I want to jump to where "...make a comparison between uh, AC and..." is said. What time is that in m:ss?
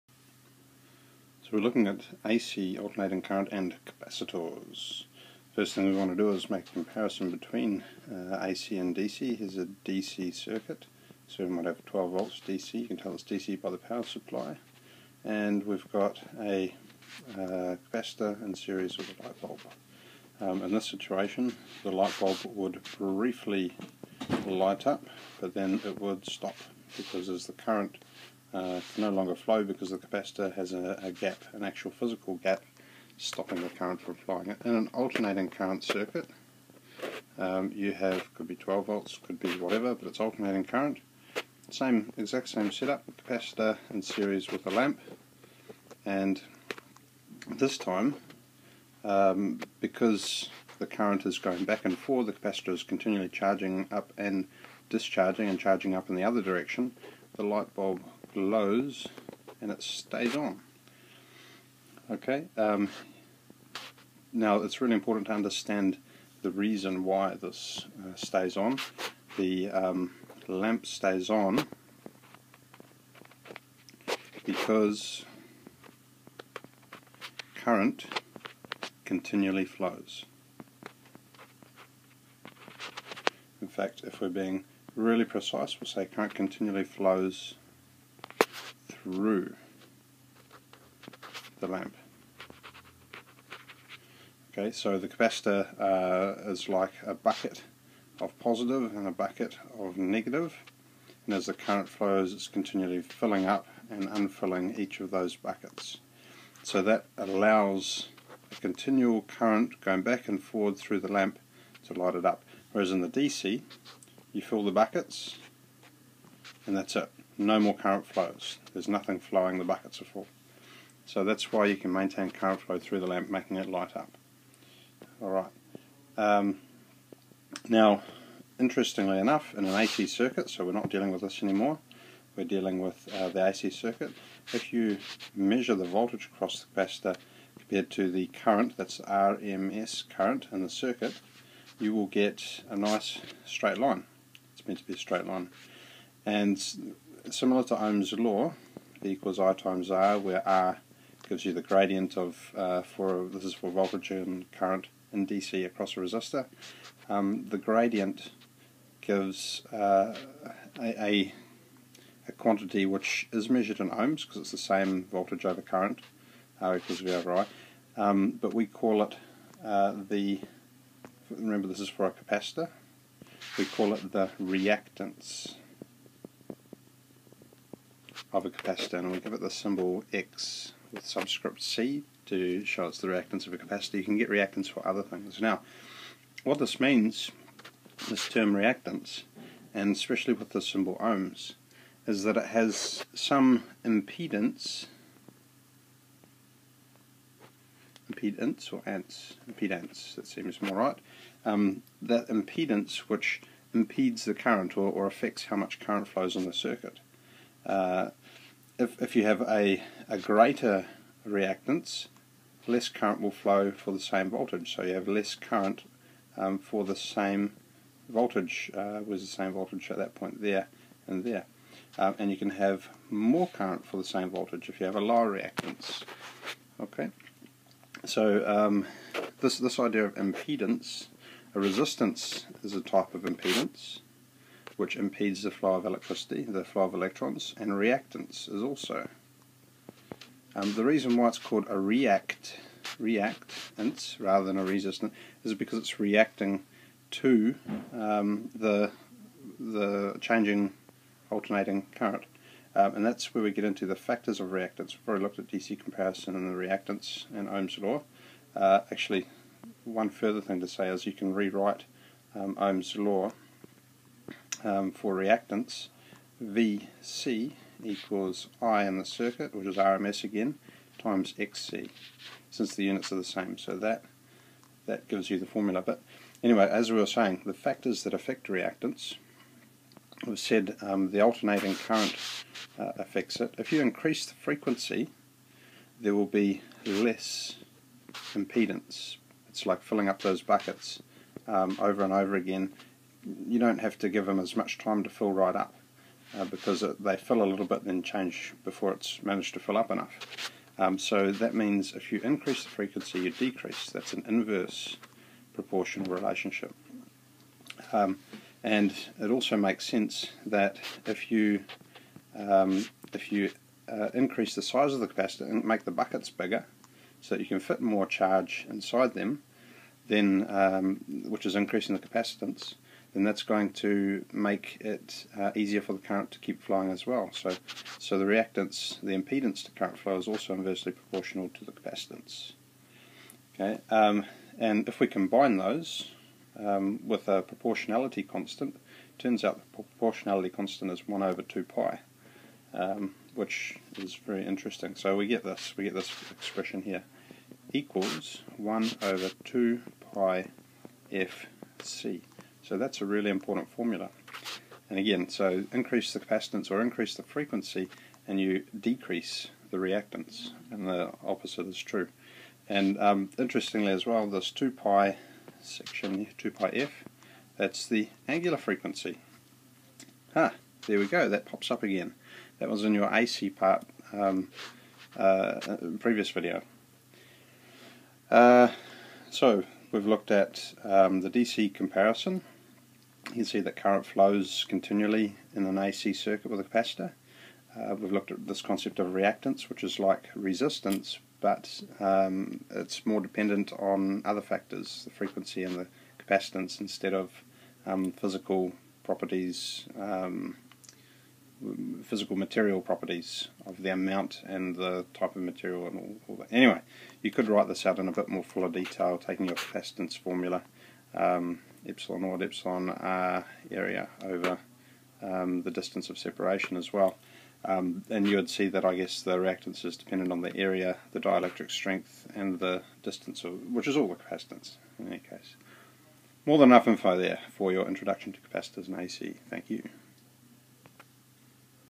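0:06.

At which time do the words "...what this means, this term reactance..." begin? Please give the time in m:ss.
3:06.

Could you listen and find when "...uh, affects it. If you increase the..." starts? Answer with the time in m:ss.
4:42.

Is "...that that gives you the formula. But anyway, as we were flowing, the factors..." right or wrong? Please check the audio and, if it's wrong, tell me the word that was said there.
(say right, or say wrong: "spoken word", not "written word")
wrong: "saying", not "flowing".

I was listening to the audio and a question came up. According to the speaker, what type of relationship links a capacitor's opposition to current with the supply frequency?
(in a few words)
Inverse proportional.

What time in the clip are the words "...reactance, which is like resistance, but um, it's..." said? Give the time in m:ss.
6:29.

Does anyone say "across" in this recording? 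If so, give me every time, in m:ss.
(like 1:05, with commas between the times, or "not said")
2:16, 2:35.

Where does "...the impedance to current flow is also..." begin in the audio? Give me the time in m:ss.
5:29.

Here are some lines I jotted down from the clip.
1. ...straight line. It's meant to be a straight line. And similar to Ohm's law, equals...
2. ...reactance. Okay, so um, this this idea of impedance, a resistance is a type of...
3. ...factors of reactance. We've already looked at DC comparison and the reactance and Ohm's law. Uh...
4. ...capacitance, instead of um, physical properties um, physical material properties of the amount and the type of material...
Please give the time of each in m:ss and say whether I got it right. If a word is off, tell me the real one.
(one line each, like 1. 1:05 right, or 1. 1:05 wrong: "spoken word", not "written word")
1. 2:23 right
2. 3:45 right
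3. 4:13 right
4. 6:36 right.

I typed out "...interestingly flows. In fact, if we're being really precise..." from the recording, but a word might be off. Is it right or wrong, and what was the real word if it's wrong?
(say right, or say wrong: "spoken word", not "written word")
wrong: "continually", not "interestingly".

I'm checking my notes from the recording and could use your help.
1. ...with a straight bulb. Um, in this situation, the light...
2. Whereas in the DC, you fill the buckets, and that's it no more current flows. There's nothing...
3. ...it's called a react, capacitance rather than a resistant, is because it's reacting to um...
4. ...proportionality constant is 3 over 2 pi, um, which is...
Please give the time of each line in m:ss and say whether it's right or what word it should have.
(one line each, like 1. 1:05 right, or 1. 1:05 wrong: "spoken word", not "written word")
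1. 0:18 wrong: "light", not "straight"
2. 1:52 right
3. 4:01 wrong: "reactance", not "capacitance"
4. 5:39 wrong: "1", not "3".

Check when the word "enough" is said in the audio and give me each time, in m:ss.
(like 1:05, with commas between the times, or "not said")
2:09, 4:59, 7:06.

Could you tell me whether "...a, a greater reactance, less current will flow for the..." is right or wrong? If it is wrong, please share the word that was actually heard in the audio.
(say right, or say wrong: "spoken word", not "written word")
right.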